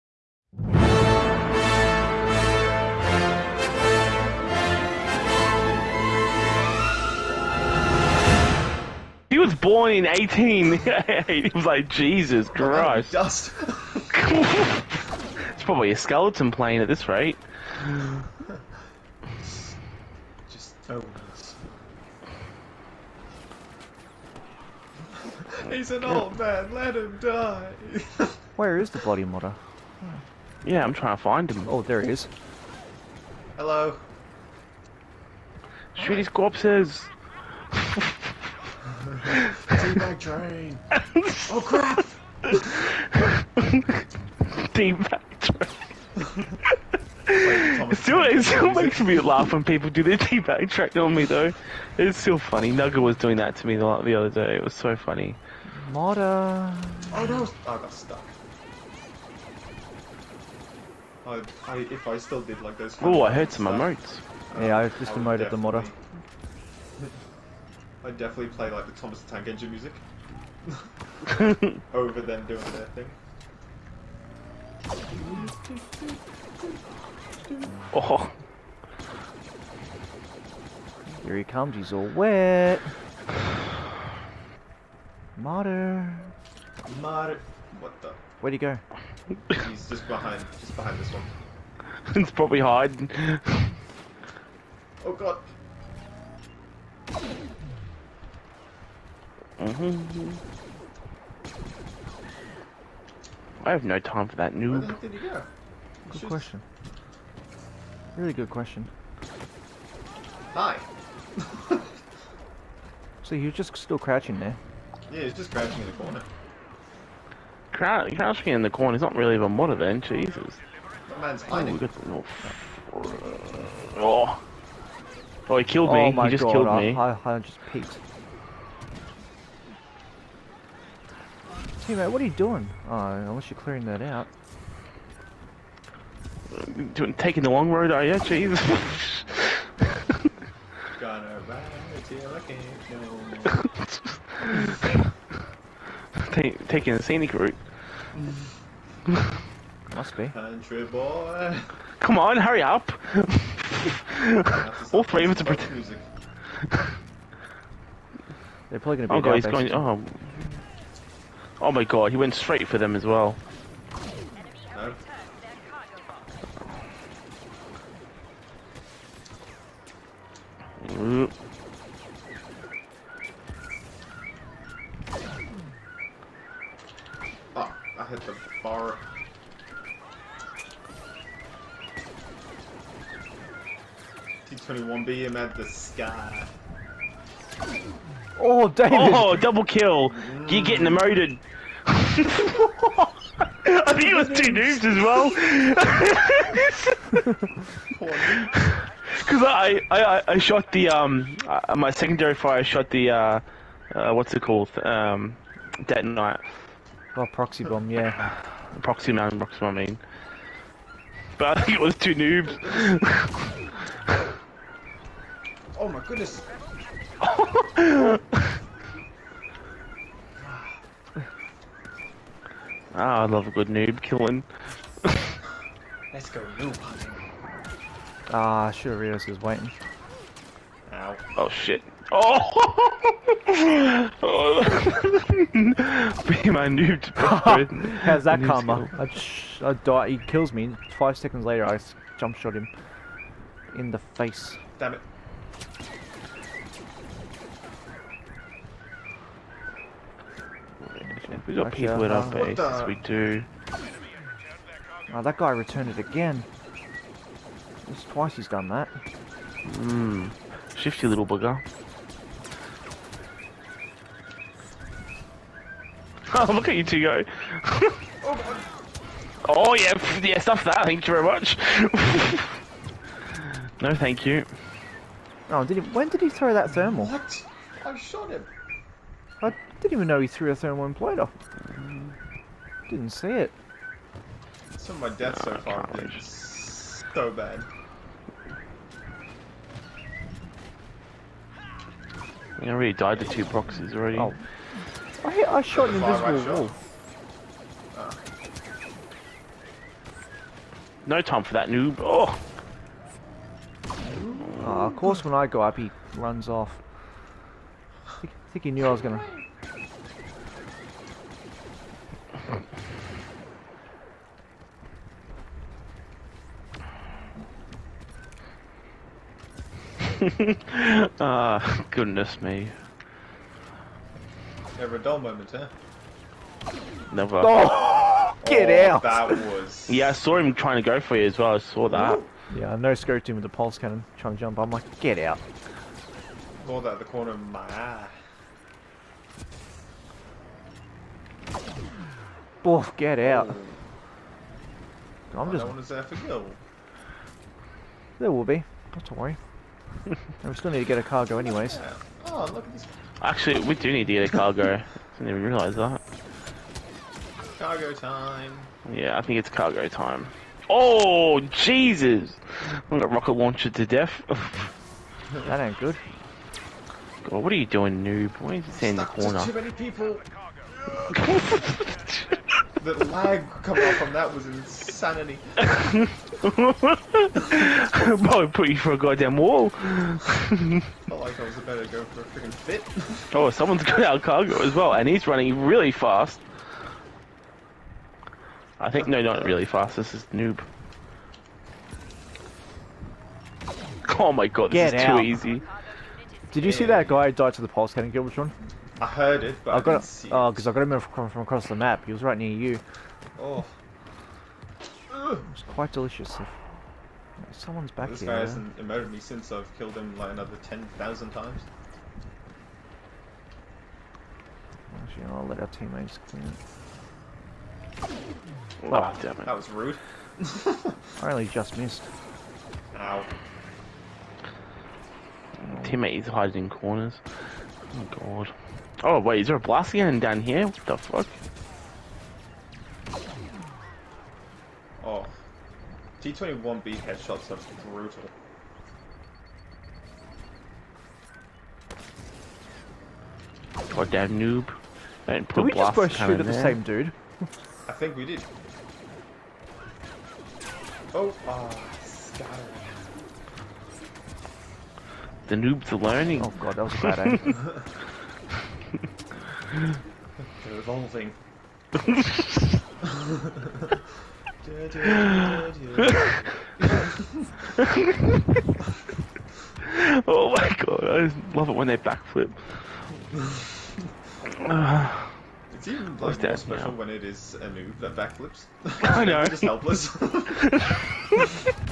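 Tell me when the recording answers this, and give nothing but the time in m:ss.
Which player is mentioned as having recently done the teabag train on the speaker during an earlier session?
0:52.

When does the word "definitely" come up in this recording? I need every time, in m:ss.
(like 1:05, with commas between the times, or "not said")
1:08.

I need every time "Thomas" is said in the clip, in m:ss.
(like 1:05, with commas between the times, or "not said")
1:08.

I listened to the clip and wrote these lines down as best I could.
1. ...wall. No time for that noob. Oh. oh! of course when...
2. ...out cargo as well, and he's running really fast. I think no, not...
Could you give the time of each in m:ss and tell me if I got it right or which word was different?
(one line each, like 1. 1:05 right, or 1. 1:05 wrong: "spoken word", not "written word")
1. 4:56 right
2. 6:24 right.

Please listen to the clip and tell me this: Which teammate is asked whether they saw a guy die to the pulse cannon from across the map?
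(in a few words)
Giltron.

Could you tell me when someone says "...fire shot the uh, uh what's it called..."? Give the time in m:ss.
3:22.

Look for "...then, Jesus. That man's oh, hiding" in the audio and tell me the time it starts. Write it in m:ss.
1:59.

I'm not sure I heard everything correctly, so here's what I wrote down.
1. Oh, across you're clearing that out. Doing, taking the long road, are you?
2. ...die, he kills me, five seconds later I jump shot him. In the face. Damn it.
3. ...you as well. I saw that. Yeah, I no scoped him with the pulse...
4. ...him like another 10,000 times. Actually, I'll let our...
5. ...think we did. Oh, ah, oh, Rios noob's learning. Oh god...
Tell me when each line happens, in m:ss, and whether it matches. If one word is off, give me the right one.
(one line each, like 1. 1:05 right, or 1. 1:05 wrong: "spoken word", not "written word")
1. 2:12 wrong: "unless", not "across"
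2. 3:59 right
3. 5:31 right
4. 6:49 right
5. 7:27 wrong: "The", not "Rios".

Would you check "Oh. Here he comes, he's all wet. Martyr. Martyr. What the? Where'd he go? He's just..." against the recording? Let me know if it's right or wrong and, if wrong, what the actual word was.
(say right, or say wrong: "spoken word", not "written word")
right.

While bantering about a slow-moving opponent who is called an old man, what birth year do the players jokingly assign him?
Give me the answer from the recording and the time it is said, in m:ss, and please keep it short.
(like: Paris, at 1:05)
18, at 0:09.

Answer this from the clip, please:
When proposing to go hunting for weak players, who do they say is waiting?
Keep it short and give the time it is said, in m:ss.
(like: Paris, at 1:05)
Rios, at 3:48.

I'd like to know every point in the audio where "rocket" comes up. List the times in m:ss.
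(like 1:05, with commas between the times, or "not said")
6:03.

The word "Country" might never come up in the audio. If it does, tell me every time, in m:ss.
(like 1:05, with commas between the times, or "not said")
2:30.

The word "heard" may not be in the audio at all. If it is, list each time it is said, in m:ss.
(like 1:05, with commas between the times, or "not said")
1:03, 6:39.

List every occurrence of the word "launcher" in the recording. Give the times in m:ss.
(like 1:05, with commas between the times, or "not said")
6:03.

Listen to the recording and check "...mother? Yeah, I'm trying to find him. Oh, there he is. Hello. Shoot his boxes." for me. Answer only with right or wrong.
wrong.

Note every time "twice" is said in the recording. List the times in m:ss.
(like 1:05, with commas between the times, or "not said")
4:18.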